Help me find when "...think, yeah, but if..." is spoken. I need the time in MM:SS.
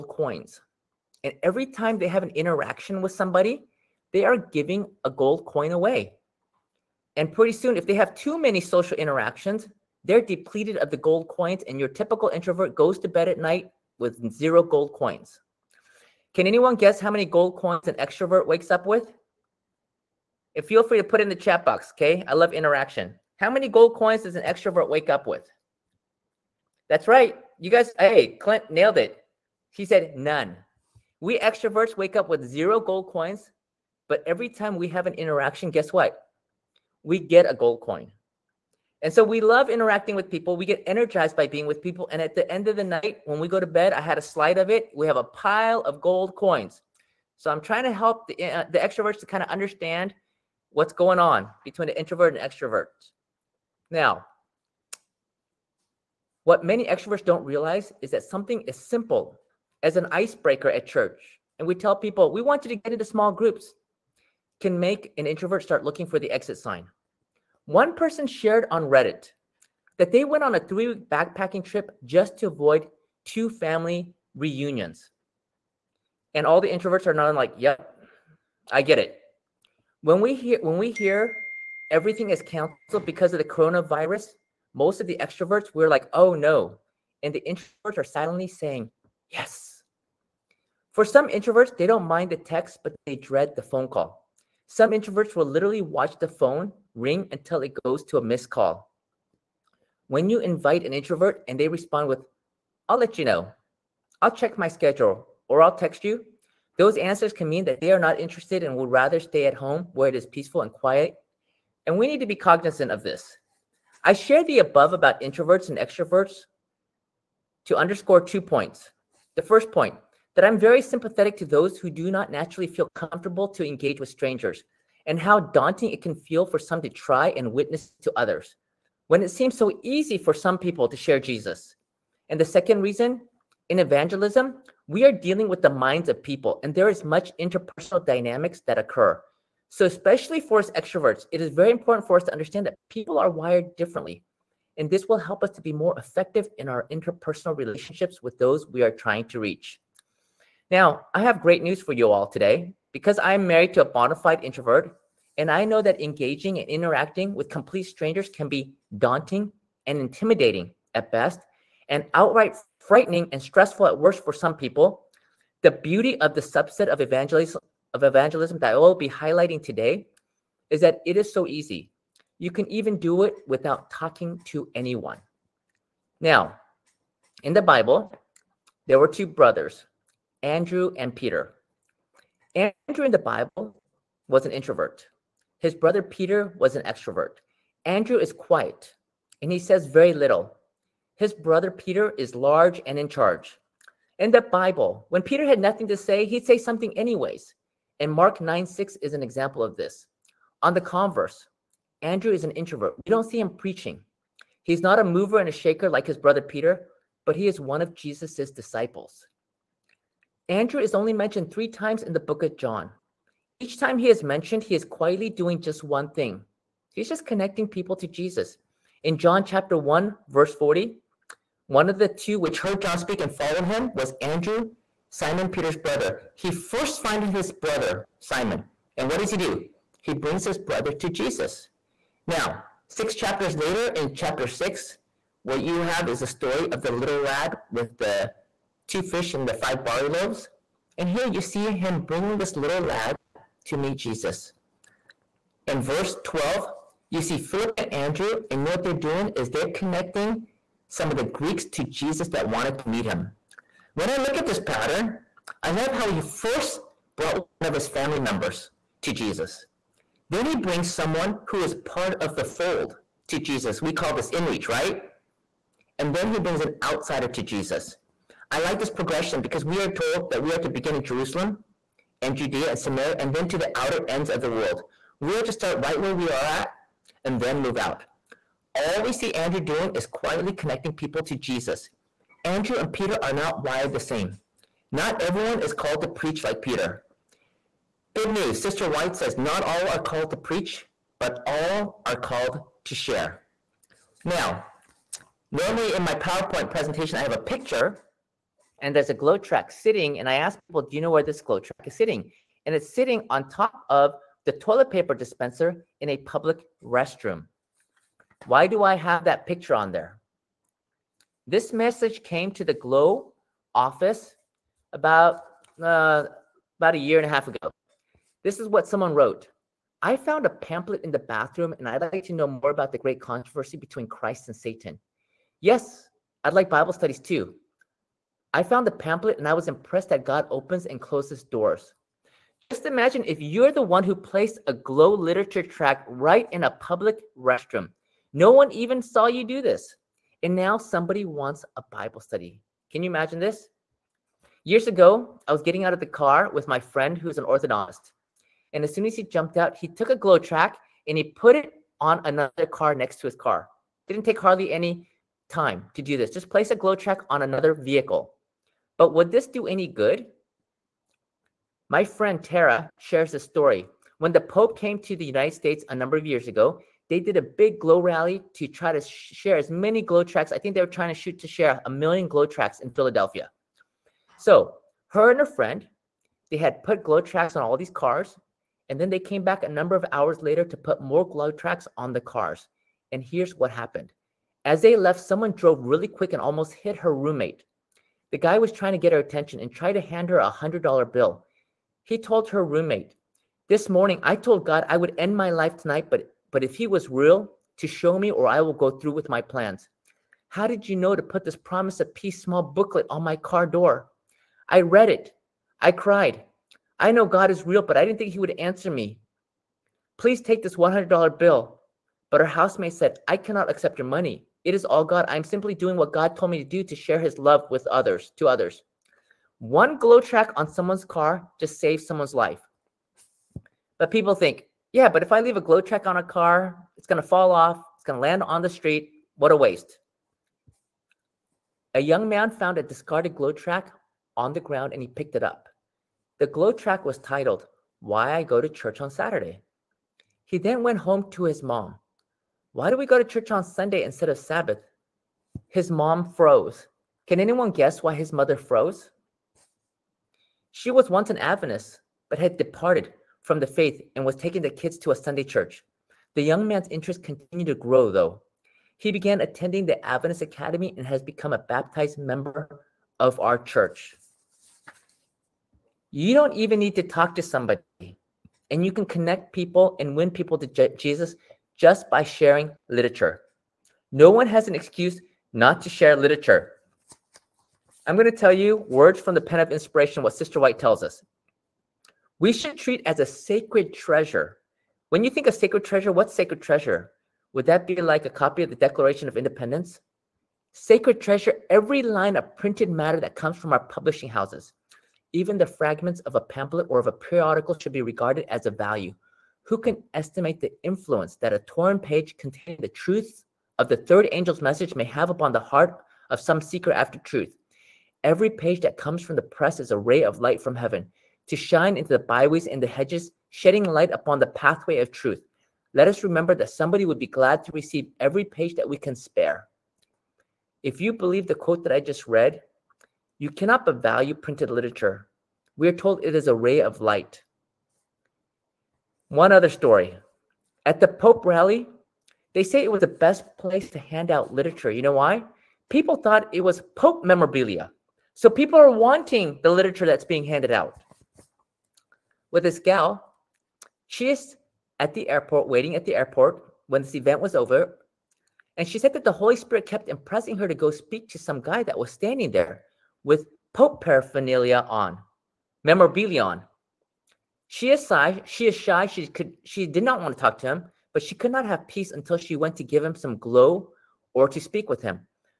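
07:04.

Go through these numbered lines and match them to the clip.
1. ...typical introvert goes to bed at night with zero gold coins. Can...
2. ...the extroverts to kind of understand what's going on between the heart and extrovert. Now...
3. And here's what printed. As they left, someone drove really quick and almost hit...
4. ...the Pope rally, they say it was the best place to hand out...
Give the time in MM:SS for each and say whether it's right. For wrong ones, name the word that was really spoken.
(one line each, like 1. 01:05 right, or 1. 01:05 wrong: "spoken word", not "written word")
1. 00:11 right
2. 00:48 wrong: "introvert", not "heart"
3. 06:23 wrong: "happened", not "printed"
4. 08:51 right.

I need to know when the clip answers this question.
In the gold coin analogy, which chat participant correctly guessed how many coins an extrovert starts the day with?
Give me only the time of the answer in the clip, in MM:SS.
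00:28.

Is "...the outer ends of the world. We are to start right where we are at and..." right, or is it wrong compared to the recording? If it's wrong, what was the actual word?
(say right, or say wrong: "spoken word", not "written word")
right.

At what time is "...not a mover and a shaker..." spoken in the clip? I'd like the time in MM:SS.
03:24.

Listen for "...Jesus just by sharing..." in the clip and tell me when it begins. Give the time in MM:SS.
07:50.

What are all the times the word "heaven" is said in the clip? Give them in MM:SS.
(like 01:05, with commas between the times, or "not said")
08:30.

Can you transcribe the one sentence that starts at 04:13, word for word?
When I look at this pattern, I love how he first brought one of his family members to Jesus.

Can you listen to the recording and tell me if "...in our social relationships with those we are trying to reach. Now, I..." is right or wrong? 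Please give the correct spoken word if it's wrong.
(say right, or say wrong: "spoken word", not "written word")
wrong: "interpersonal", not "social".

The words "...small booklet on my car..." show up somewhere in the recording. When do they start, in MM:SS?
06:42.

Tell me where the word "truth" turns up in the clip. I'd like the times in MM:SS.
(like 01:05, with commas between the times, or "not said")
08:22, 08:27, 08:35.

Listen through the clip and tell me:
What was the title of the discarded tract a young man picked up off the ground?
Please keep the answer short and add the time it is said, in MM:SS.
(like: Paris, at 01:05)
Why I Go to Church on Saturday, at 07:18.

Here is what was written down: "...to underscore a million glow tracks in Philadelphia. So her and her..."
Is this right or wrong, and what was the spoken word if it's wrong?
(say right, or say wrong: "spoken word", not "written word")
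wrong: "share", not "underscore".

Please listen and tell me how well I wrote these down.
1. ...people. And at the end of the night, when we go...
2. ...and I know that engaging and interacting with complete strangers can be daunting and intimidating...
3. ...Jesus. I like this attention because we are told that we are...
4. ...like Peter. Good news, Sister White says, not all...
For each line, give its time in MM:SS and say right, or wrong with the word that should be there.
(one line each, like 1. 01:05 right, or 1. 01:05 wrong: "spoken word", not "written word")
1. 00:41 right
2. 02:35 right
3. 04:27 wrong: "progression", not "attention"
4. 04:46 right.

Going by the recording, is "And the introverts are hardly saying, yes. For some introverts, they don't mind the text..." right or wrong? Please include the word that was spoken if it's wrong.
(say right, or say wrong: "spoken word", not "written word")
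wrong: "silently", not "hardly".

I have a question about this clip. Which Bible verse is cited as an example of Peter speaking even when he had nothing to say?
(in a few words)
Mark 9:6.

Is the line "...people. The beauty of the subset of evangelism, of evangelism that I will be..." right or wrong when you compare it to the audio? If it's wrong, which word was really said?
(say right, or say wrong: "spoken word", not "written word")
right.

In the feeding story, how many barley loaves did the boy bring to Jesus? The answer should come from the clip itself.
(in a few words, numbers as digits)
5.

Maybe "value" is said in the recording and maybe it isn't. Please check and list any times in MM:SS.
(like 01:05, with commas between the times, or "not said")
08:18, 08:44.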